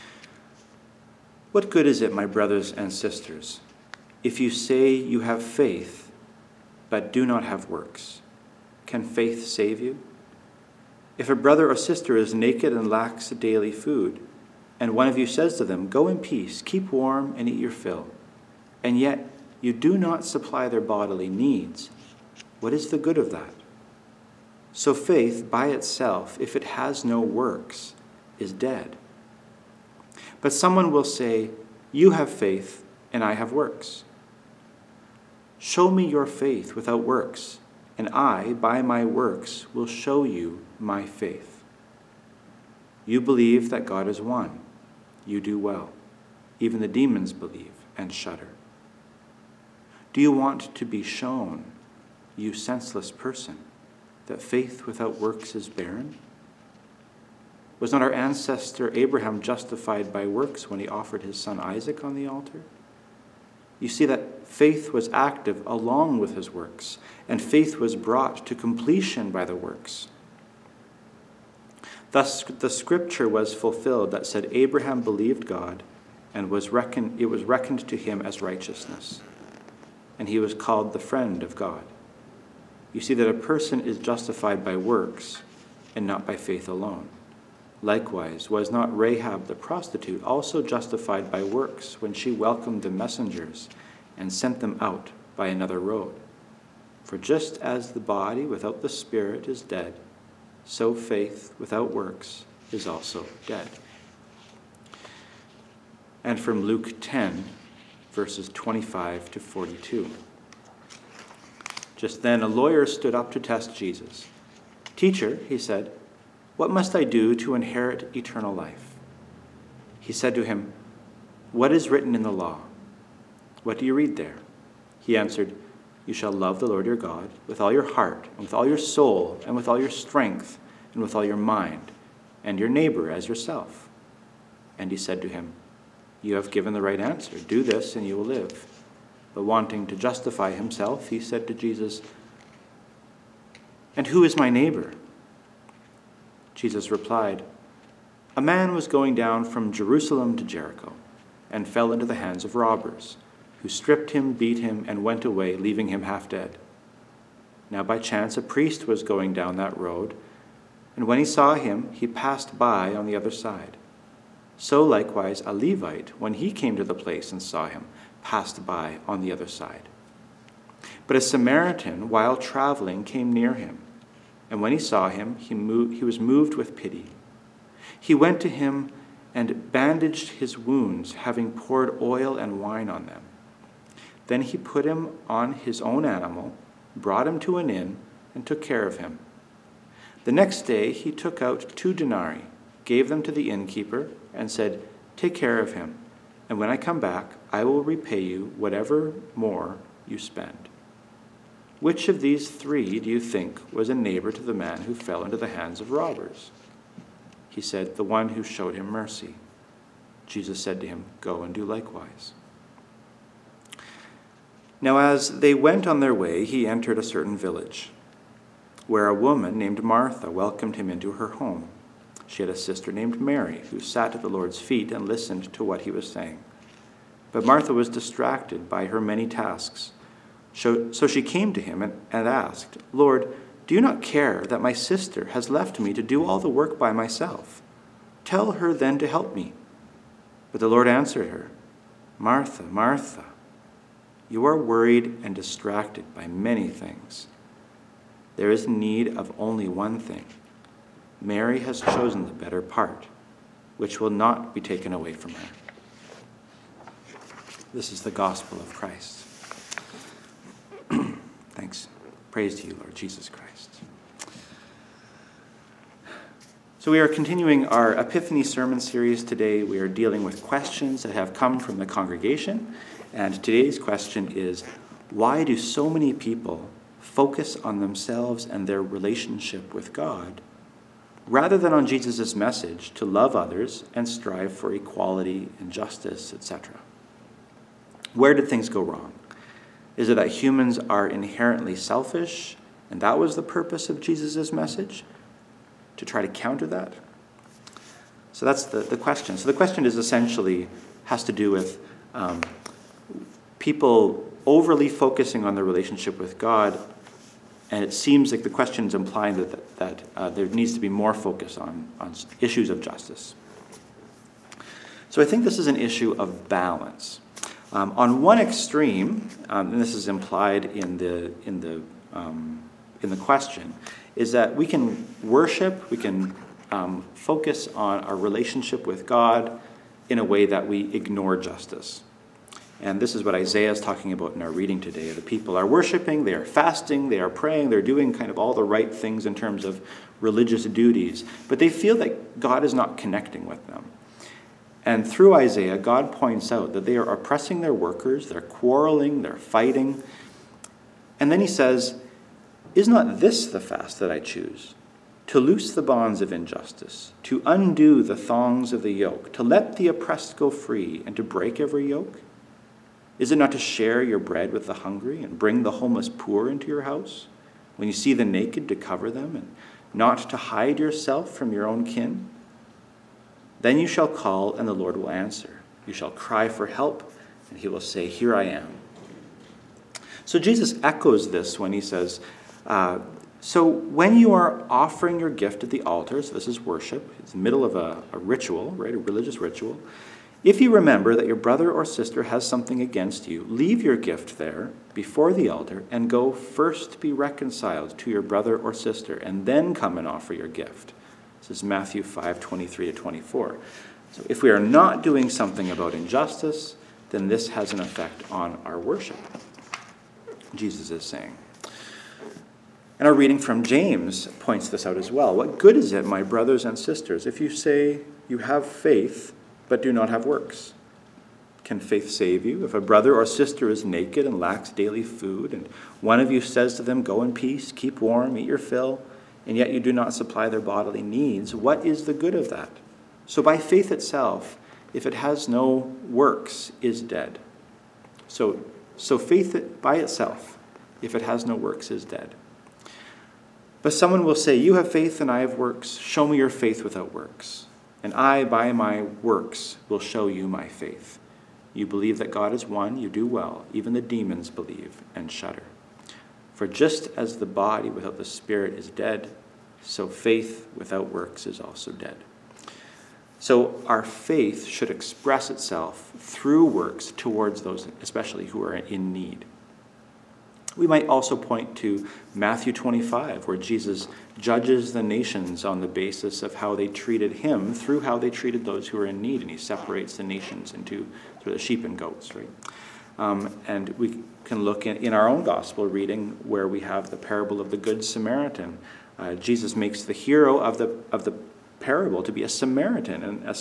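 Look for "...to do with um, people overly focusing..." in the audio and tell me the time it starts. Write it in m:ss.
5:01.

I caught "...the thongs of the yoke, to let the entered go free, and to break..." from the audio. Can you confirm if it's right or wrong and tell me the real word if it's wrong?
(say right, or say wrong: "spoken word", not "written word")
wrong: "oppressed", not "entered".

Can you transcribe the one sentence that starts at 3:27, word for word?
He said, The one who showed him mercy.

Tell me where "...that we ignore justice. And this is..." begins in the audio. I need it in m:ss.
5:30.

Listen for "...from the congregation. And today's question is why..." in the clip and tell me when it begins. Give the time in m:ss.
4:31.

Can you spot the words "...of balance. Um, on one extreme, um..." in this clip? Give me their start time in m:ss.
5:16.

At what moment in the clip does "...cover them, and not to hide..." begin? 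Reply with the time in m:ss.
6:08.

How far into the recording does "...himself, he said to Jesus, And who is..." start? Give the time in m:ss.
2:20.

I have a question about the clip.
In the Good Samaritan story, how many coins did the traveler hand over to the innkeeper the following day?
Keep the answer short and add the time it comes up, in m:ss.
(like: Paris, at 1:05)
2 denarii, at 3:11.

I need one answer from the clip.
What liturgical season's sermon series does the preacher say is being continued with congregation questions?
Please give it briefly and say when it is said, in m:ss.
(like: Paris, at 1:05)
Epiphany, at 4:27.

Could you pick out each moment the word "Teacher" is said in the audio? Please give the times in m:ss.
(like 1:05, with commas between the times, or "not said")
1:54.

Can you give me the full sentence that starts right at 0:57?
Was not our ancestor Abraham justified by works when he offered his son Isaac on the altar?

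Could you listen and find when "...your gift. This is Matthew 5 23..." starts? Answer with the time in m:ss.
6:40.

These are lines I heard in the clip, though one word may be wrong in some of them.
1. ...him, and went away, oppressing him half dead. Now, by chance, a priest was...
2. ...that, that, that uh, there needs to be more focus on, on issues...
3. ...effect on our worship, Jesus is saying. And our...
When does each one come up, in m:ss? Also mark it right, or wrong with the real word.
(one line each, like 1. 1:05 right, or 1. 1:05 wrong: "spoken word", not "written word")
1. 2:34 wrong: "leaving", not "oppressing"
2. 5:09 right
3. 6:47 right.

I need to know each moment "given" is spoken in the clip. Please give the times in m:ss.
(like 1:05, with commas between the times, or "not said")
2:16.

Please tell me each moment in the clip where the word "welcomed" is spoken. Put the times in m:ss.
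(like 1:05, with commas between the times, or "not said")
1:32, 3:40.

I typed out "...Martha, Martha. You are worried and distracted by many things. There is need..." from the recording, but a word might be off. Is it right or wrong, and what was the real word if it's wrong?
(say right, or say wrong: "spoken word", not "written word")
right.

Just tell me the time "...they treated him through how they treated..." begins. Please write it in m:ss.
7:56.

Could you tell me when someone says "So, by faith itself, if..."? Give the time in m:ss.
7:13.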